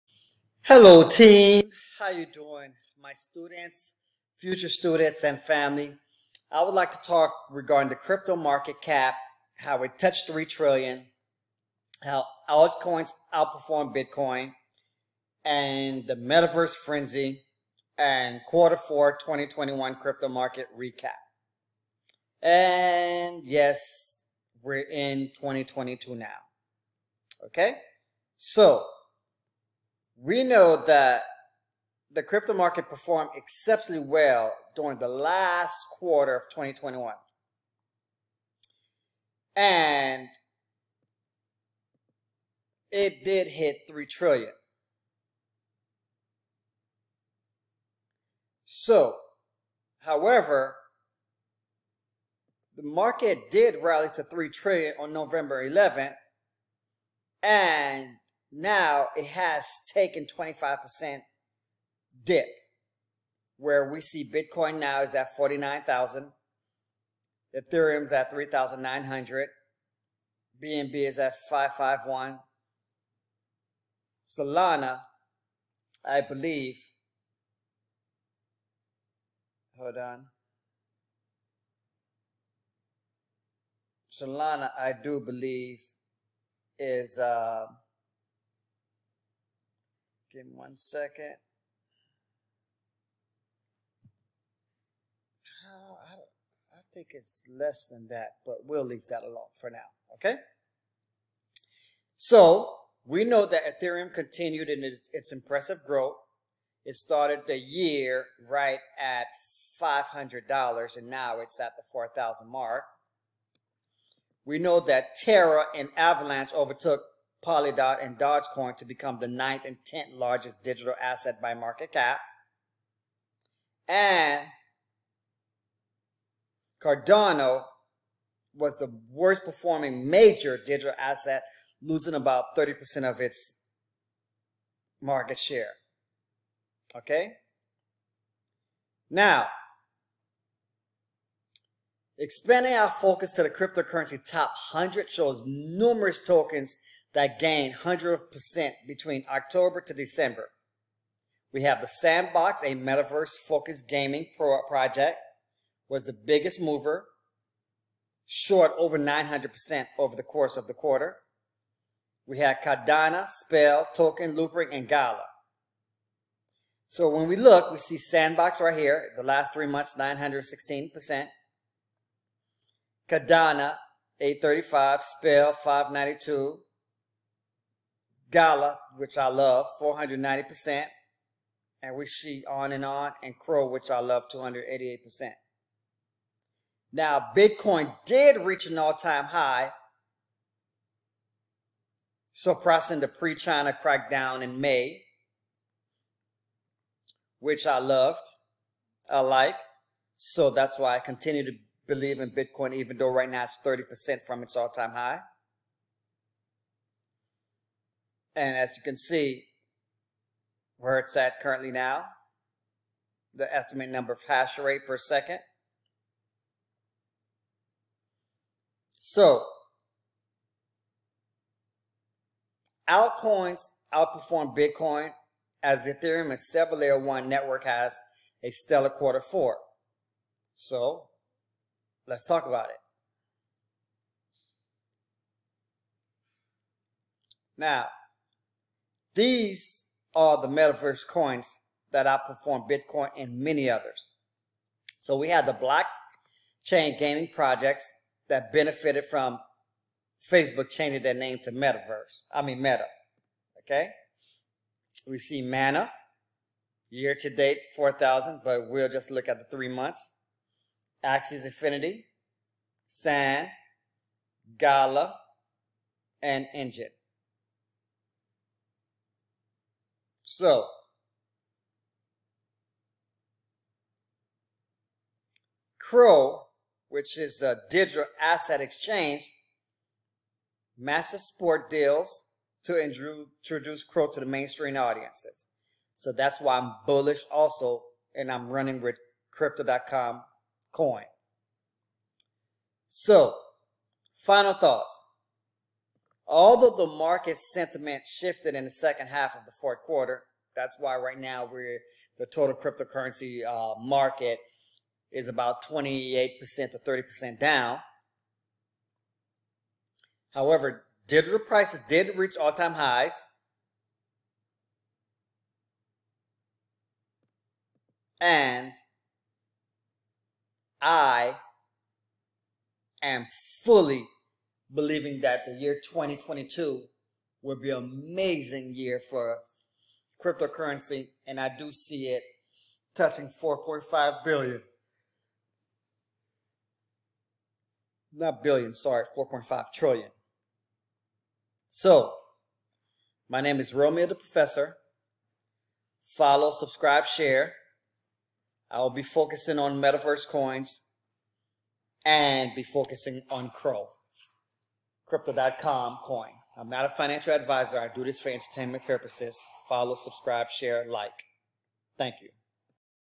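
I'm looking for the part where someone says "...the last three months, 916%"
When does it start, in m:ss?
2:49.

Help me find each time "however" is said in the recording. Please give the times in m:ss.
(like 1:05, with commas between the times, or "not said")
0:50, 5:10.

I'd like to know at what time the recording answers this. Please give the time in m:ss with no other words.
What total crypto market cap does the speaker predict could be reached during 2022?
5:39.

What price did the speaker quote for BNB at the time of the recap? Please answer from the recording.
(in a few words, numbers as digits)
551.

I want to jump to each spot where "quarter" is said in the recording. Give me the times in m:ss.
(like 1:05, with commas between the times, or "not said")
0:18, 0:35, 2:40, 3:48, 4:59.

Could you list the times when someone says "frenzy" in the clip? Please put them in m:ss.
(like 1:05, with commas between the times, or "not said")
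0:16.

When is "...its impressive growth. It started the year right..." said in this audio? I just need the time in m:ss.
1:45.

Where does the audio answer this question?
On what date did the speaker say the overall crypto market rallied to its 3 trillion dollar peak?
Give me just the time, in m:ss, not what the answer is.
0:55.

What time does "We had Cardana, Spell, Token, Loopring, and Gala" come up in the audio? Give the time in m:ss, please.
2:42.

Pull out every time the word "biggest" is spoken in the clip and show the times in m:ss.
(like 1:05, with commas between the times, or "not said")
2:36.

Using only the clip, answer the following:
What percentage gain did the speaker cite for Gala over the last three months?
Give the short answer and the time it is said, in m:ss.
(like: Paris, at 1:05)
490%, at 2:59.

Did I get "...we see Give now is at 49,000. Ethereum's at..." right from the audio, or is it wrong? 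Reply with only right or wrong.
wrong.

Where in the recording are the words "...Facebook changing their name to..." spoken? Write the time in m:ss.
4:10.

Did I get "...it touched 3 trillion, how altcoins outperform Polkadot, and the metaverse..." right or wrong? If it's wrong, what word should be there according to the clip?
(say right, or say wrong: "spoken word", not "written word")
wrong: "Bitcoin", not "Polkadot".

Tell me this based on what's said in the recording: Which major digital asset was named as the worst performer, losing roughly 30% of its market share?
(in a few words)
Cardano.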